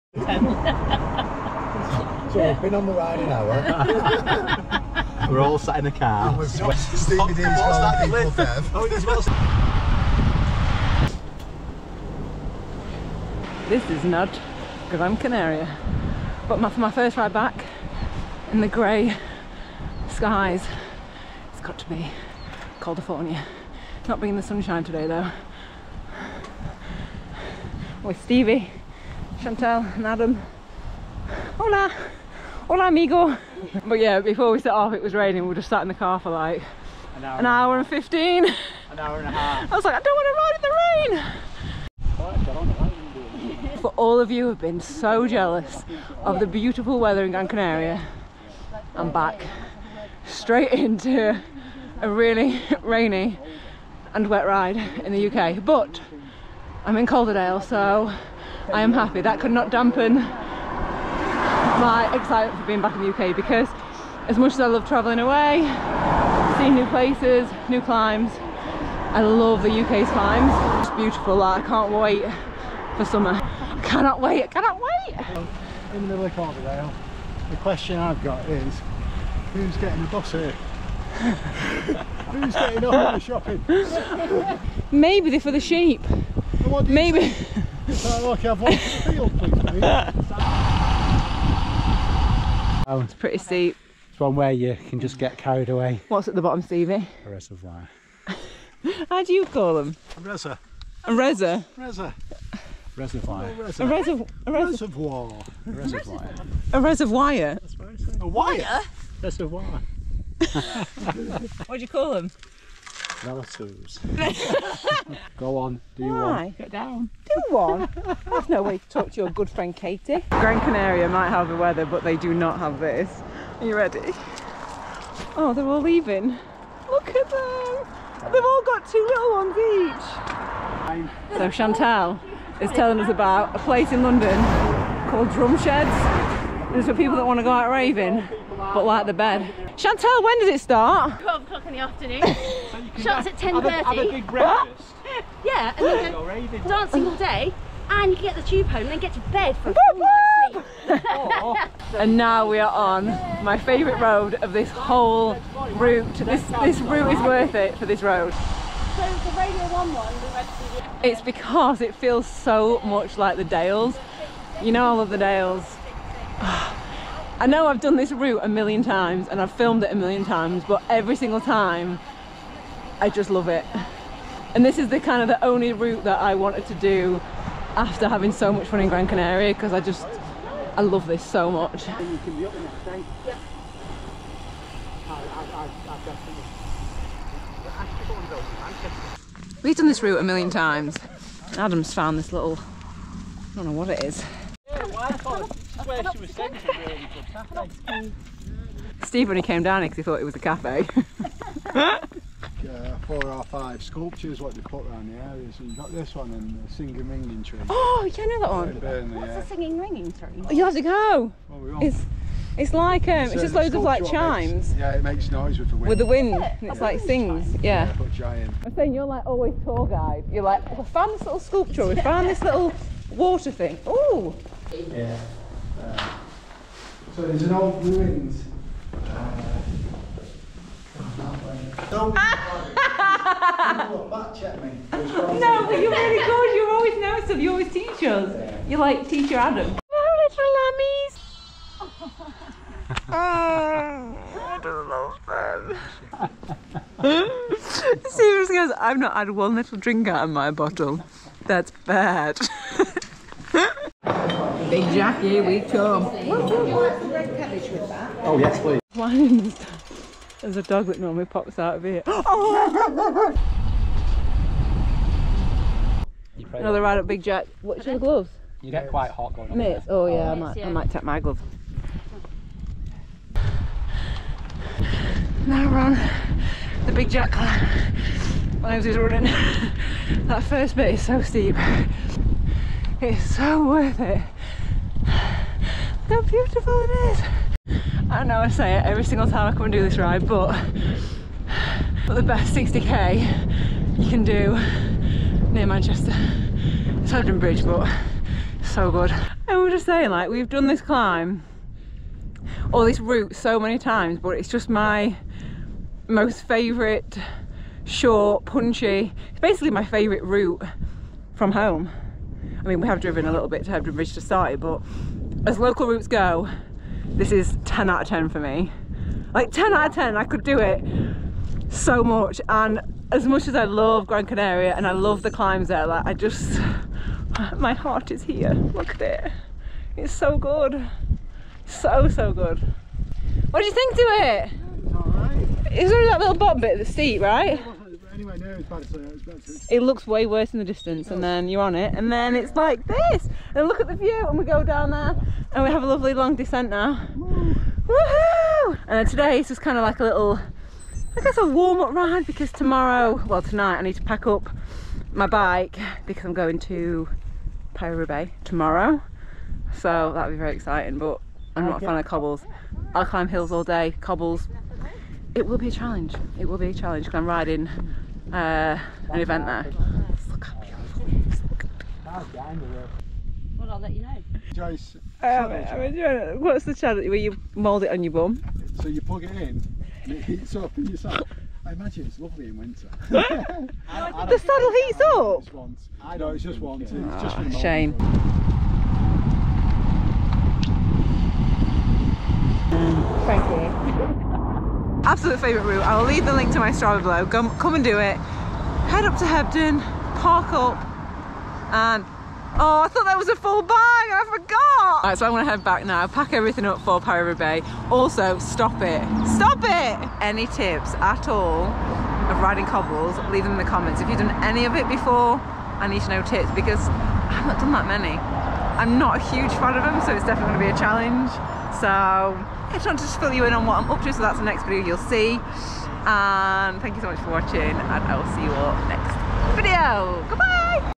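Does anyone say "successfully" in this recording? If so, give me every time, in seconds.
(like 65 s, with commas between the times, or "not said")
not said.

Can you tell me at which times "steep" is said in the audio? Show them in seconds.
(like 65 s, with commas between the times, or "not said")
93 s, 281 s, 336 s.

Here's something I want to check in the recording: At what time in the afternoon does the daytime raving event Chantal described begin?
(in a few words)
12 o'clock.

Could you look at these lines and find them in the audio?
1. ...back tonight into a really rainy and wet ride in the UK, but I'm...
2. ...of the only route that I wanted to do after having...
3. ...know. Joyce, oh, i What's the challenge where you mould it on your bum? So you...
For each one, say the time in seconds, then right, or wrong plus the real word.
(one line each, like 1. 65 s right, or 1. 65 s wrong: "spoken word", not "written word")
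1. 49 s wrong: "straight", not "tonight"
2. 175 s right
3. 374 s right.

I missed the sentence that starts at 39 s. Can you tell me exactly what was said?
I was like, I don't want to ride in the rain!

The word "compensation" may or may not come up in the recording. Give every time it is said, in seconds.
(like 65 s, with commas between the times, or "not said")
not said.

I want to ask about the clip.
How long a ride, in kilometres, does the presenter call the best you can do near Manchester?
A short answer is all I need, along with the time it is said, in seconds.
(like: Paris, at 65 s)
60k, at 292 s.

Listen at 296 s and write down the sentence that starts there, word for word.
It's Hebden Bridge, but so good.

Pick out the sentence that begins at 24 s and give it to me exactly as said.
Not being in the sunshine today though.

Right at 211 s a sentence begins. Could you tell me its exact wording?
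Well, it's, it's like, um, it's, it's just loads of like chimes.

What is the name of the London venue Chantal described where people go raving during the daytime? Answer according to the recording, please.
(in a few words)
Drumsheds.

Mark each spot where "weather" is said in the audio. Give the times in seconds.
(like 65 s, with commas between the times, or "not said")
46 s, 121 s.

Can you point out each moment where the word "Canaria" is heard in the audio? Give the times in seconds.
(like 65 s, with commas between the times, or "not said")
15 s, 47 s, 120 s, 179 s, 324 s.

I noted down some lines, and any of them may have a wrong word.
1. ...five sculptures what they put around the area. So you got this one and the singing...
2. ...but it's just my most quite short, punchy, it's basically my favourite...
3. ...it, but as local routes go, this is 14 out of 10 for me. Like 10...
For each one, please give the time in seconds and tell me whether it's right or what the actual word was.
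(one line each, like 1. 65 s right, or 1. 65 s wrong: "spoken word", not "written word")
1. 203 s right
2. 304 s wrong: "favourite", not "quite"
3. 314 s wrong: "10", not "14".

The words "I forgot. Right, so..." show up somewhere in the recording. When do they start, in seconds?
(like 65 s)
403 s.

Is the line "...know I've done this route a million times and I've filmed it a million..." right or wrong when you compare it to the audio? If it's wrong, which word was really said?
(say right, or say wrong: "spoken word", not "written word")
right.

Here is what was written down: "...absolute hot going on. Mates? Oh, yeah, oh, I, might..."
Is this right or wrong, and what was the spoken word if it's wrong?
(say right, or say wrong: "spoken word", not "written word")
wrong: "quite", not "absolute".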